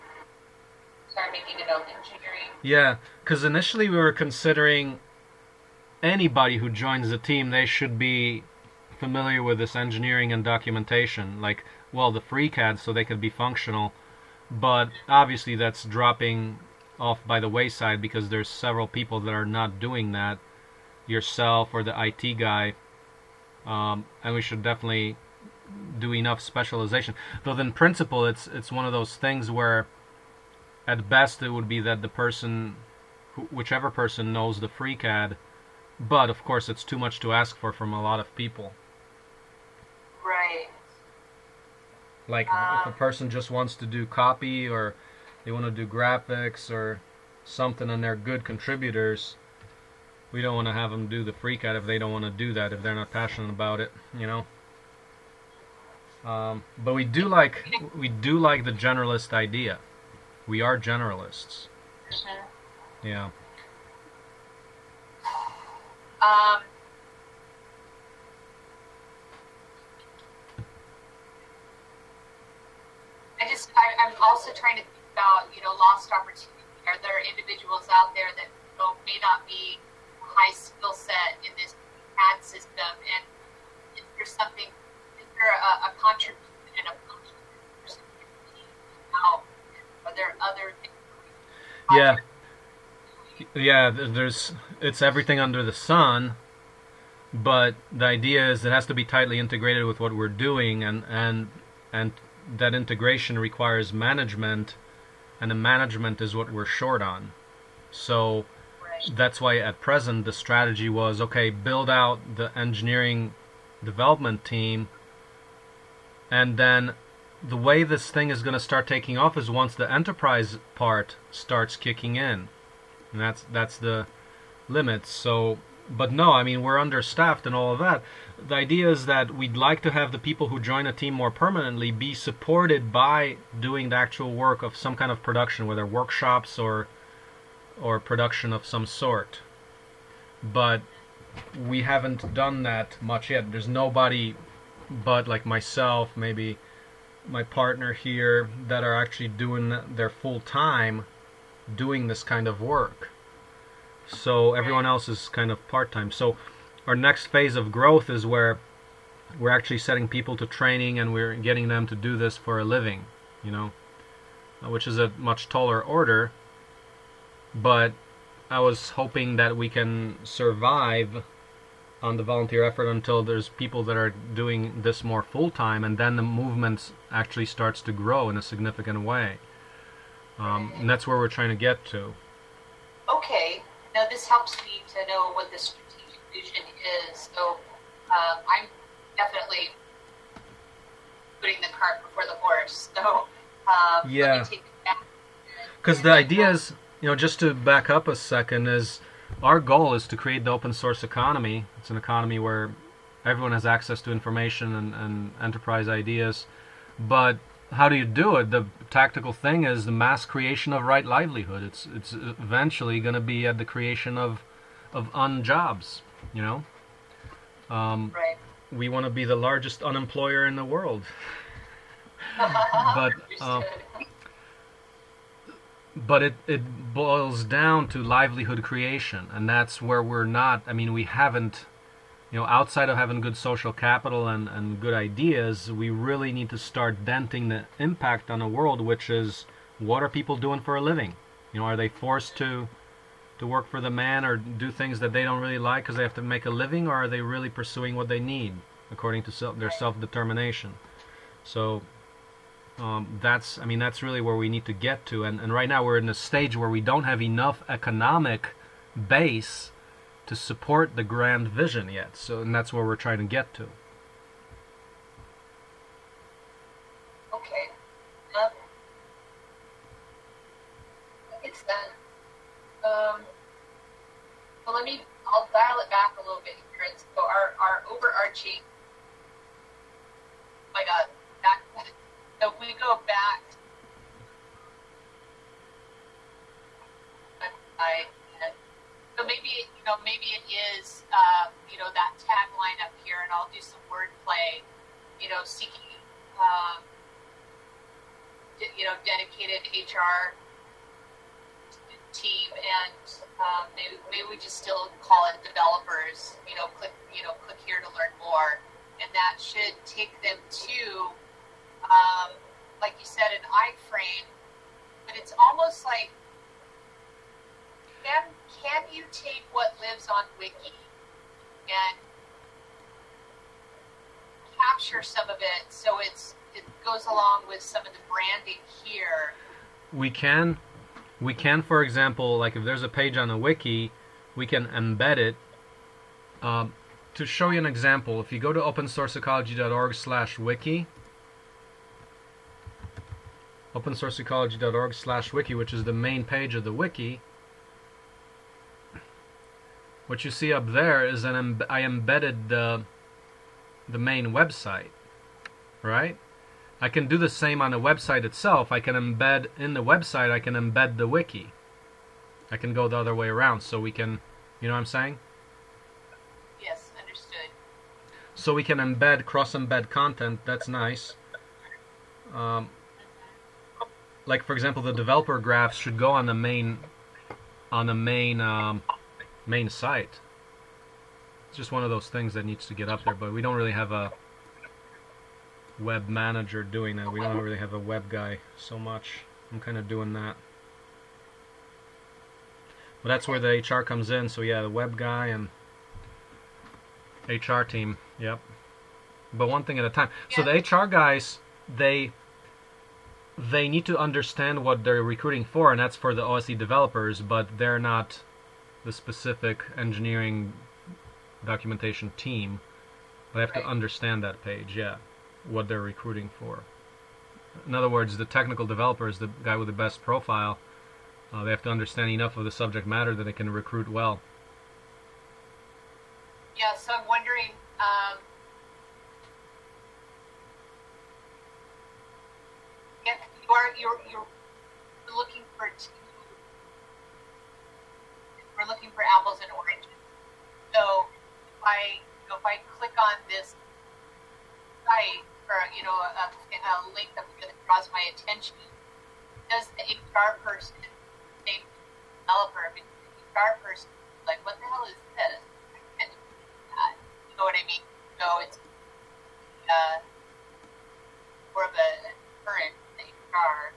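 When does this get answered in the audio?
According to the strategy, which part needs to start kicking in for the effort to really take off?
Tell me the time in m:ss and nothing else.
1:59.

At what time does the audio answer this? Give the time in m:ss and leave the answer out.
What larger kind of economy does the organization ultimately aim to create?
3:20.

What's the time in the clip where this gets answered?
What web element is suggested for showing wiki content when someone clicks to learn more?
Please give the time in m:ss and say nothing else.
5:13.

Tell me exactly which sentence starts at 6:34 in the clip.
So yeah, the web guy and HR team.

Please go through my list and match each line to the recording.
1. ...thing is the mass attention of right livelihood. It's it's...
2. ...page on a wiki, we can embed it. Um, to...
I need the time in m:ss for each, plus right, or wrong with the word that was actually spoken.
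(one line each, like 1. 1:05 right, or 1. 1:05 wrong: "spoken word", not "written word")
1. 3:29 wrong: "creation", not "attention"
2. 5:32 right.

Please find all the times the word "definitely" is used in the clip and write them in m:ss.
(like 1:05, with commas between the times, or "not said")
0:24, 3:09.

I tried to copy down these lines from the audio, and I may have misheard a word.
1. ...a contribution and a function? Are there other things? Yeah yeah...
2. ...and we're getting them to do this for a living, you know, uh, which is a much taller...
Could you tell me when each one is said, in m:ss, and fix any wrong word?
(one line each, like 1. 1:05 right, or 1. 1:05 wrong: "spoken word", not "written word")
1. 1:25 right
2. 2:40 right.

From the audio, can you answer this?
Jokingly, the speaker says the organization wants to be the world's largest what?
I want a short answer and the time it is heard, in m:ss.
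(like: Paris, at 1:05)
Unemployer, at 3:39.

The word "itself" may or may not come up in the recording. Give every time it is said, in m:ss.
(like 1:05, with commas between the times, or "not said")
5:58.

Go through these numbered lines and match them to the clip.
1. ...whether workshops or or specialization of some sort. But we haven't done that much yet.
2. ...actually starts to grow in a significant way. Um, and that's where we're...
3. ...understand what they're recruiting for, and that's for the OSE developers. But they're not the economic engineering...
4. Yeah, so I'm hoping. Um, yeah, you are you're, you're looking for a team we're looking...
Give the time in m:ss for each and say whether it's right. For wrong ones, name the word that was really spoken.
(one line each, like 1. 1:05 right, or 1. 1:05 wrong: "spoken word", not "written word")
1. 2:15 wrong: "production", not "specialization"
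2. 2:57 right
3. 6:43 wrong: "specific", not "economic"
4. 7:06 wrong: "wondering", not "hoping".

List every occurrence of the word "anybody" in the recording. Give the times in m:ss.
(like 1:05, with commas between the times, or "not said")
0:06.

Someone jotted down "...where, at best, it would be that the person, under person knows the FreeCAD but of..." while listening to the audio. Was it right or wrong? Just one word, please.
wrong.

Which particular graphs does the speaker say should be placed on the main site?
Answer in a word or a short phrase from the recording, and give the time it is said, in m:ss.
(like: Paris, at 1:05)
Developer graphs, at 6:14.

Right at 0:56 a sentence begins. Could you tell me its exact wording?
Um, but we do like we do like the generalist idea.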